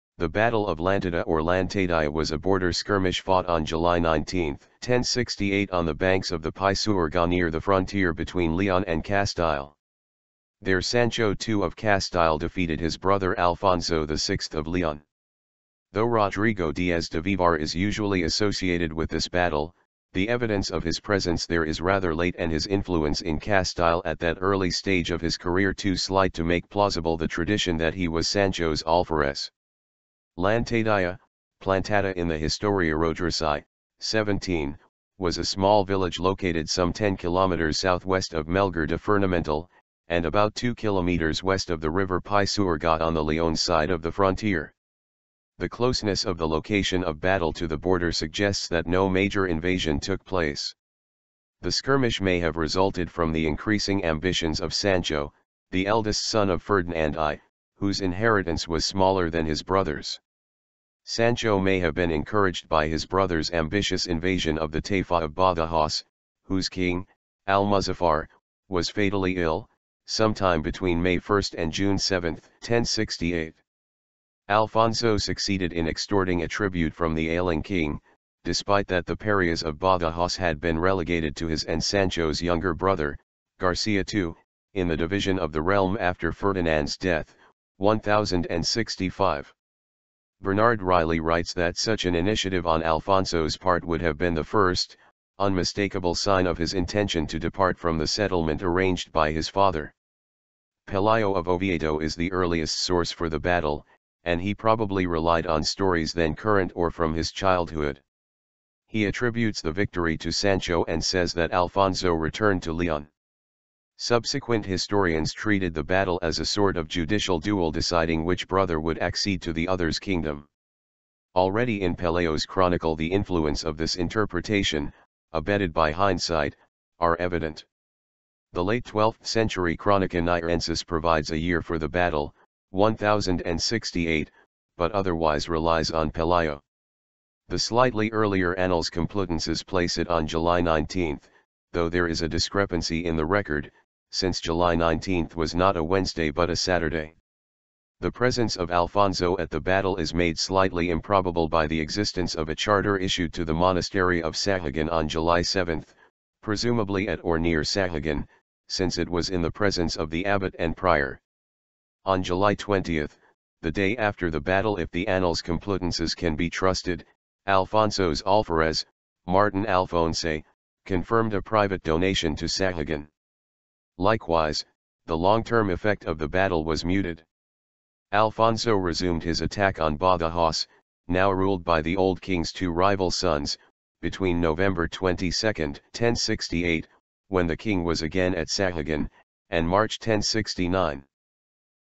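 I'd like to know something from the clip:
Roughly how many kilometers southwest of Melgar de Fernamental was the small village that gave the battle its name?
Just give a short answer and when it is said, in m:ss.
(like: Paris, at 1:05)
10, at 0:36.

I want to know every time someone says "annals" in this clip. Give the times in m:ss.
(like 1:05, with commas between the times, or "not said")
2:18, 2:45.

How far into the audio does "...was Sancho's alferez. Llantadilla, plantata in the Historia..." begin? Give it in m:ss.
0:28.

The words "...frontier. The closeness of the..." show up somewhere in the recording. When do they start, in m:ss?
0:44.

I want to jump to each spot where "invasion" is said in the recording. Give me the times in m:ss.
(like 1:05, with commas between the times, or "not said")
0:49, 1:04.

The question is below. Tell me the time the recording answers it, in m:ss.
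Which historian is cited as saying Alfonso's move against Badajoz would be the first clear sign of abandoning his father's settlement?
1:30.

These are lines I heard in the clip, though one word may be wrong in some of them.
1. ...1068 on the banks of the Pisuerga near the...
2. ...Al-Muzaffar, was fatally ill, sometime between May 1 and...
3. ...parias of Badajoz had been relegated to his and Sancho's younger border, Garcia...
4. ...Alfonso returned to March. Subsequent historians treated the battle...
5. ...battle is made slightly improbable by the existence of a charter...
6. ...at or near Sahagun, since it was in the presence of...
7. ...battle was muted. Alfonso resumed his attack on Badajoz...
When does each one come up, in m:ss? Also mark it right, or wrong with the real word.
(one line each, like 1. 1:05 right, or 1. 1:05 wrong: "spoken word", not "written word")
1. 0:04 right
2. 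1:07 right
3. 1:19 wrong: "brother", not "border"
4. 1:51 wrong: "Leon", not "March"
5. 2:29 right
6. 2:37 right
7. 2:56 right.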